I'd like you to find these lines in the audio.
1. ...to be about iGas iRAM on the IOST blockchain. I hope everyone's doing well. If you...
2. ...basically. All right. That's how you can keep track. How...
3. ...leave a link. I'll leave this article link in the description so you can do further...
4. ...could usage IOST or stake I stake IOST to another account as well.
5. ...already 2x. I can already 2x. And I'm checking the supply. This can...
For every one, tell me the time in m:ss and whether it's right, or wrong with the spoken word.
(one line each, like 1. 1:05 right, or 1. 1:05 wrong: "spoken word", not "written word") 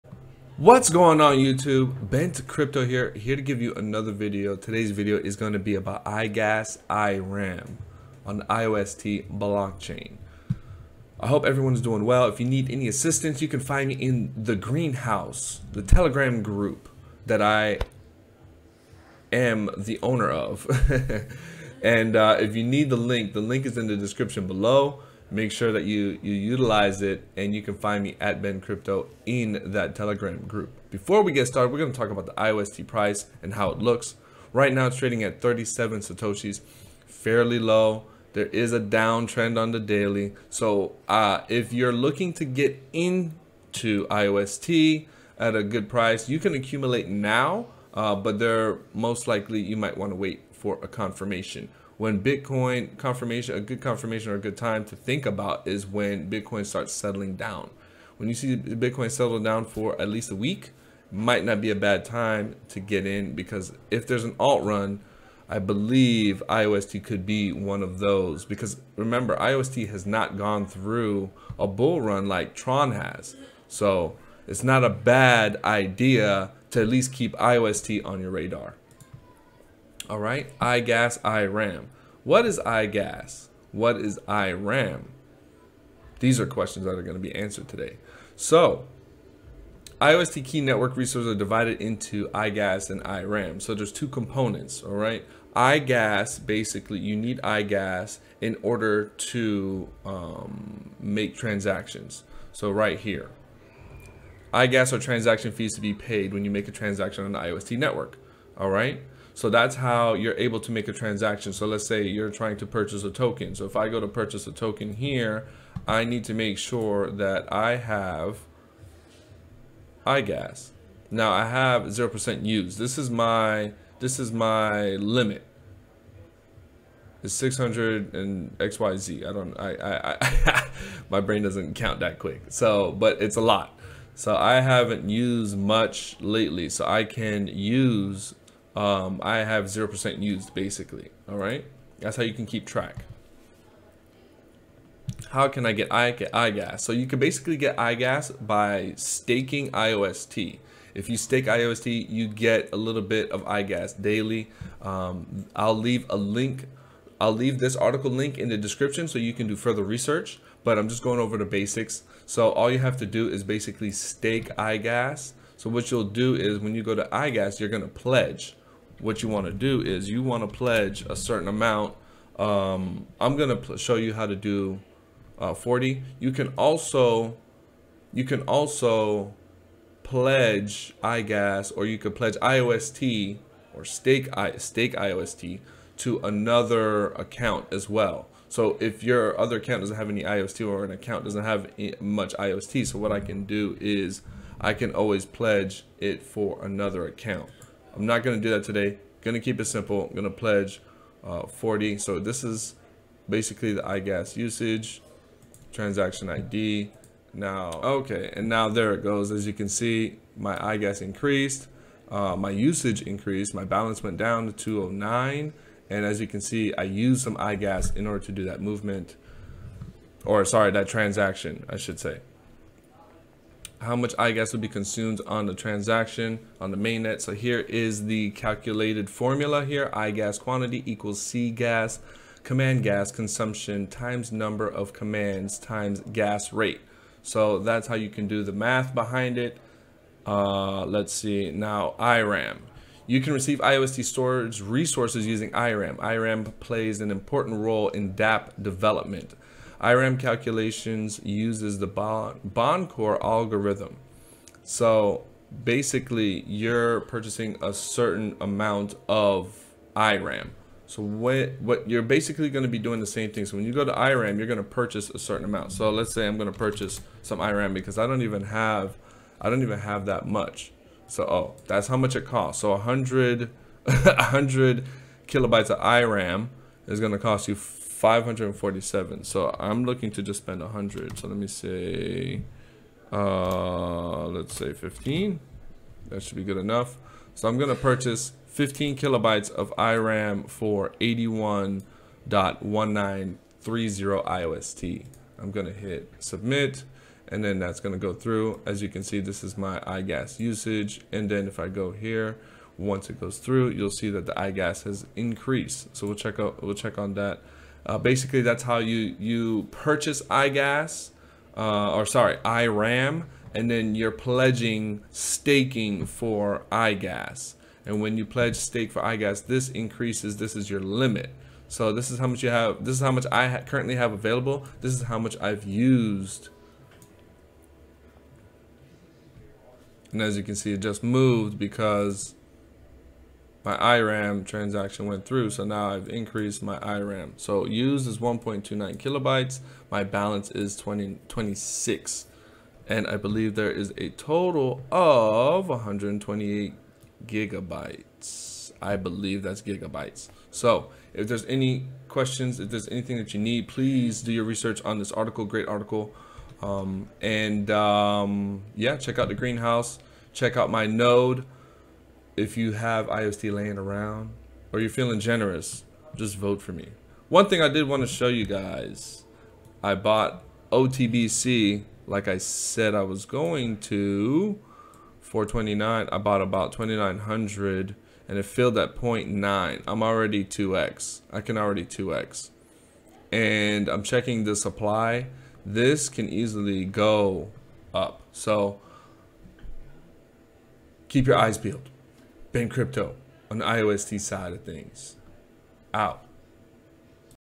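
1. 0:05 right
2. 2:20 right
3. 2:35 right
4. 3:01 wrong: "pledge", not "usage"
5. 6:20 right.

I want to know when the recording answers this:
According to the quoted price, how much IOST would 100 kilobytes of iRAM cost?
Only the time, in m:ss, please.
4:38.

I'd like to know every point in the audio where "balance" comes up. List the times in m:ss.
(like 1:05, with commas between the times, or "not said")
3:33, 5:40.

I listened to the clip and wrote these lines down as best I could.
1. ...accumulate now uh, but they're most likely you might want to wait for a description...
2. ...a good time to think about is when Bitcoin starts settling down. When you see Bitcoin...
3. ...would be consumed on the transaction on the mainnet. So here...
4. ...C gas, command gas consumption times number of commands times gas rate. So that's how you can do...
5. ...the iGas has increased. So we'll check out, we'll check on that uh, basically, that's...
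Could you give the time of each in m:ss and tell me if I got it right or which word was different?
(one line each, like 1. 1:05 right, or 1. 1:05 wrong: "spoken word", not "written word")
1. 0:46 wrong: "confirmation", not "description"
2. 0:54 right
3. 3:44 right
4. 3:51 right
5. 5:04 right.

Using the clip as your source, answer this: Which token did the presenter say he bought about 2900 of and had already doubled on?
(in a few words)
OTBC.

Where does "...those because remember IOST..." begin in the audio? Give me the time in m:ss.
1:07.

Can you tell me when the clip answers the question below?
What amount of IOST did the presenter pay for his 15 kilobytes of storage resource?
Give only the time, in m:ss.
4:50.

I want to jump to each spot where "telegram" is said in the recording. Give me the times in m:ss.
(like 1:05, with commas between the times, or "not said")
0:15, 0:29.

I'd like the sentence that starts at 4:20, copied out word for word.
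So what, what you're basically going to be doing the same thing.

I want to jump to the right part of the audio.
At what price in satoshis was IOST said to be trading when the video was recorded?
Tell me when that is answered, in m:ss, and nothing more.
0:35.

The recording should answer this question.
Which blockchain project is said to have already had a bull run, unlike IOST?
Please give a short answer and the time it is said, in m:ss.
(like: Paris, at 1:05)
Tron, at 1:12.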